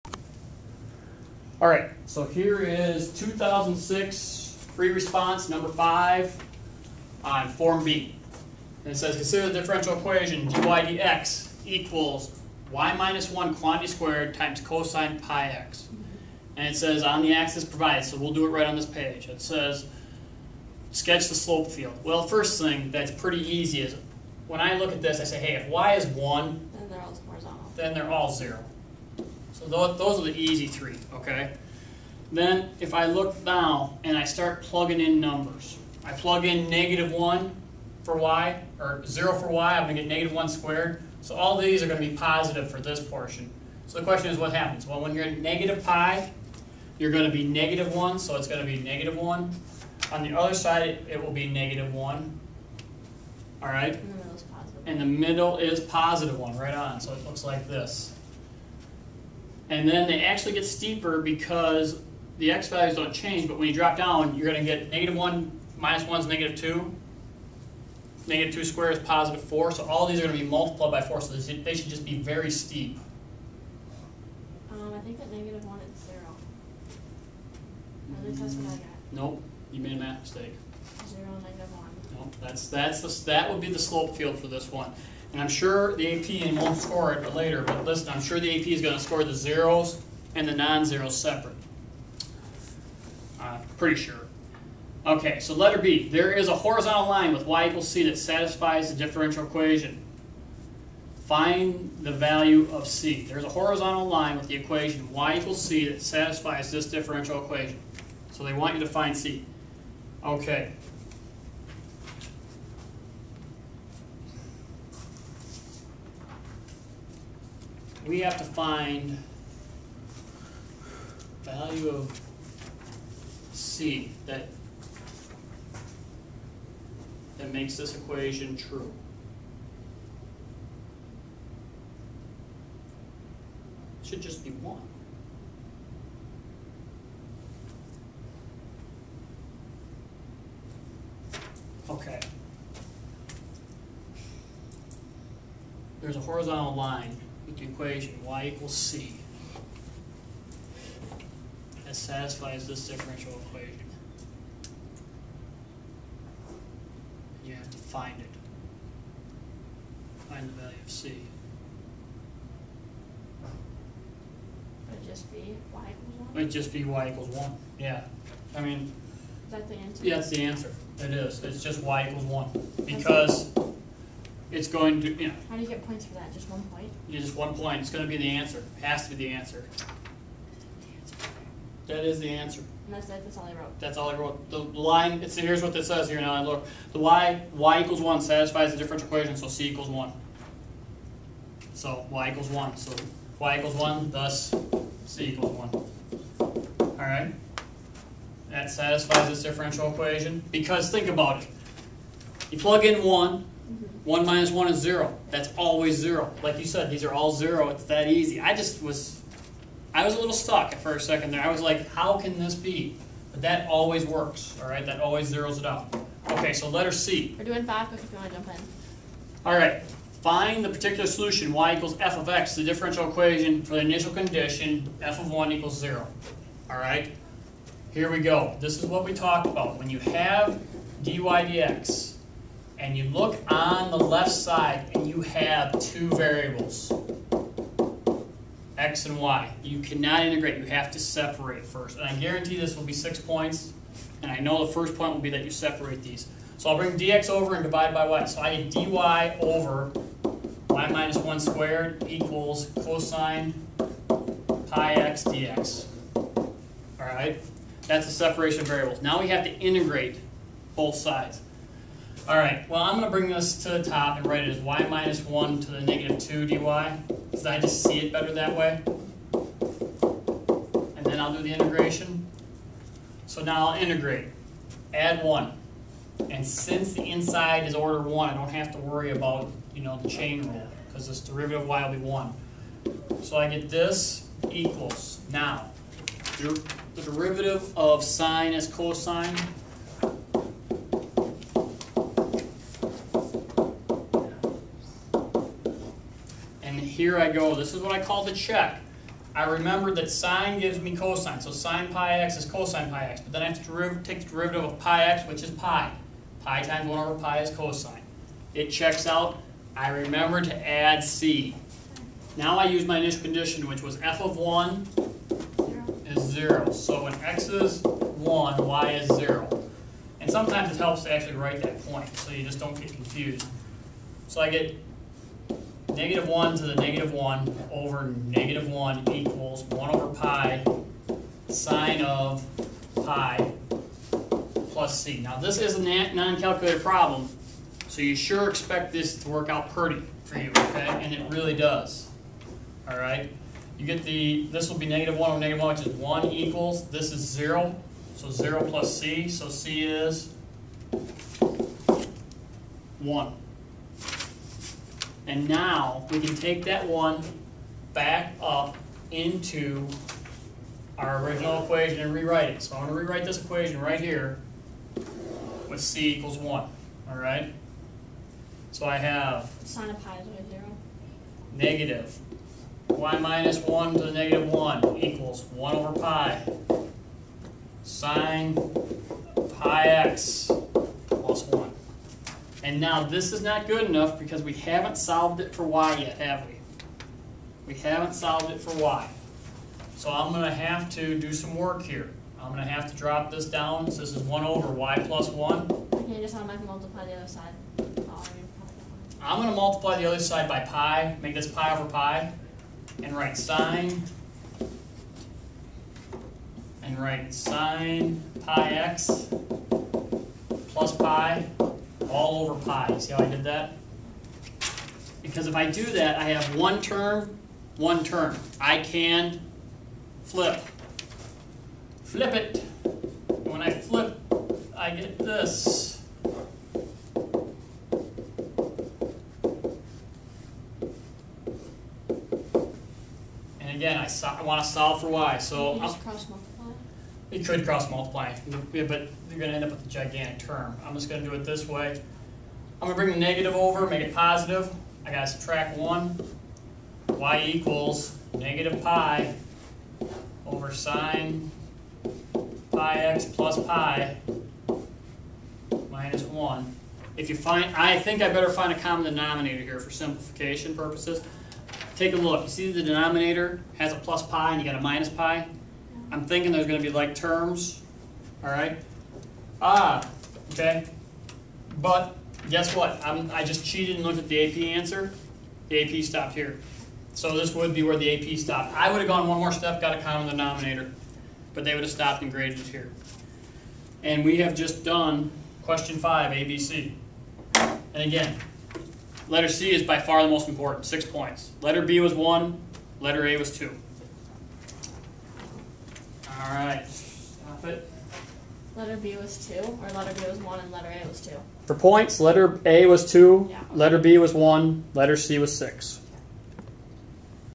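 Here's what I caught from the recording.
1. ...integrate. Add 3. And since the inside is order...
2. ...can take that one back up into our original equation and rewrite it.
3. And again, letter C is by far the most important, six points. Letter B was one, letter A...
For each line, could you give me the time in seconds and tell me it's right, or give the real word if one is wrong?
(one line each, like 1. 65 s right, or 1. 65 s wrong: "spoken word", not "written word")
1. 273 s wrong: "1", not "3"
2. 356 s right
3. 487 s right.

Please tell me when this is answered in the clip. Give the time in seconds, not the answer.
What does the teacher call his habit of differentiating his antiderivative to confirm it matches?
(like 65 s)
298 s.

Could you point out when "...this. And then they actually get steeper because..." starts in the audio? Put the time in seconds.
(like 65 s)
57 s.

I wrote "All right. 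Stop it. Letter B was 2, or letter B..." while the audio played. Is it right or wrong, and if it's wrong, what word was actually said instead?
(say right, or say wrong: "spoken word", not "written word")
right.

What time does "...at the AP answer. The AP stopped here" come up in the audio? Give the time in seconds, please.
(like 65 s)
474 s.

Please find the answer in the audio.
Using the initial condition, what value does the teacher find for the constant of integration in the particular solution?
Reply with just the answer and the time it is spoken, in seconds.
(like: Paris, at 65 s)
1, at 349 s.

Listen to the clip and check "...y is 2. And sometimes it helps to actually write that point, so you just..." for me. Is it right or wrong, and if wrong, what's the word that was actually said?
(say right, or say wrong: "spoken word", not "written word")
wrong: "0", not "2".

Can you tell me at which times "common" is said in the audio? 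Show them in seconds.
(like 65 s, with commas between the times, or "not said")
458 s, 480 s.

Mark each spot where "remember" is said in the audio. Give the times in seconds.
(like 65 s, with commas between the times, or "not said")
299 s, 309 s.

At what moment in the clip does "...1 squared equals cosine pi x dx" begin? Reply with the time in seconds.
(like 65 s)
251 s.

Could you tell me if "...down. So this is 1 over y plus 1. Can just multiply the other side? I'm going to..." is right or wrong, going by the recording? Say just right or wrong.
right.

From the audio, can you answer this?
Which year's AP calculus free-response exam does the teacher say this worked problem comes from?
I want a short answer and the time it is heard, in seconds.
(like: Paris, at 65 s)
2006, at 3 s.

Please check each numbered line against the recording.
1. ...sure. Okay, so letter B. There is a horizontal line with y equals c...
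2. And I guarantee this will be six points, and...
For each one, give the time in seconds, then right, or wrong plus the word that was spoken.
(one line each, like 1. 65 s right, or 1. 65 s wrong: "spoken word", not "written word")
1. 93 s right
2. 241 s right.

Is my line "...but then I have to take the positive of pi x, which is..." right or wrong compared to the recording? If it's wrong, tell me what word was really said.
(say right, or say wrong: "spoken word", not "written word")
wrong: "derivative", not "positive".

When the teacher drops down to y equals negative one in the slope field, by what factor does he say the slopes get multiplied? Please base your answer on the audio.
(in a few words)
4.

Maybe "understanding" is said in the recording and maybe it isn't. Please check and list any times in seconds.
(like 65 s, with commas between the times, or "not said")
not said.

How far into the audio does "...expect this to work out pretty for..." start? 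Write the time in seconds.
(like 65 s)
338 s.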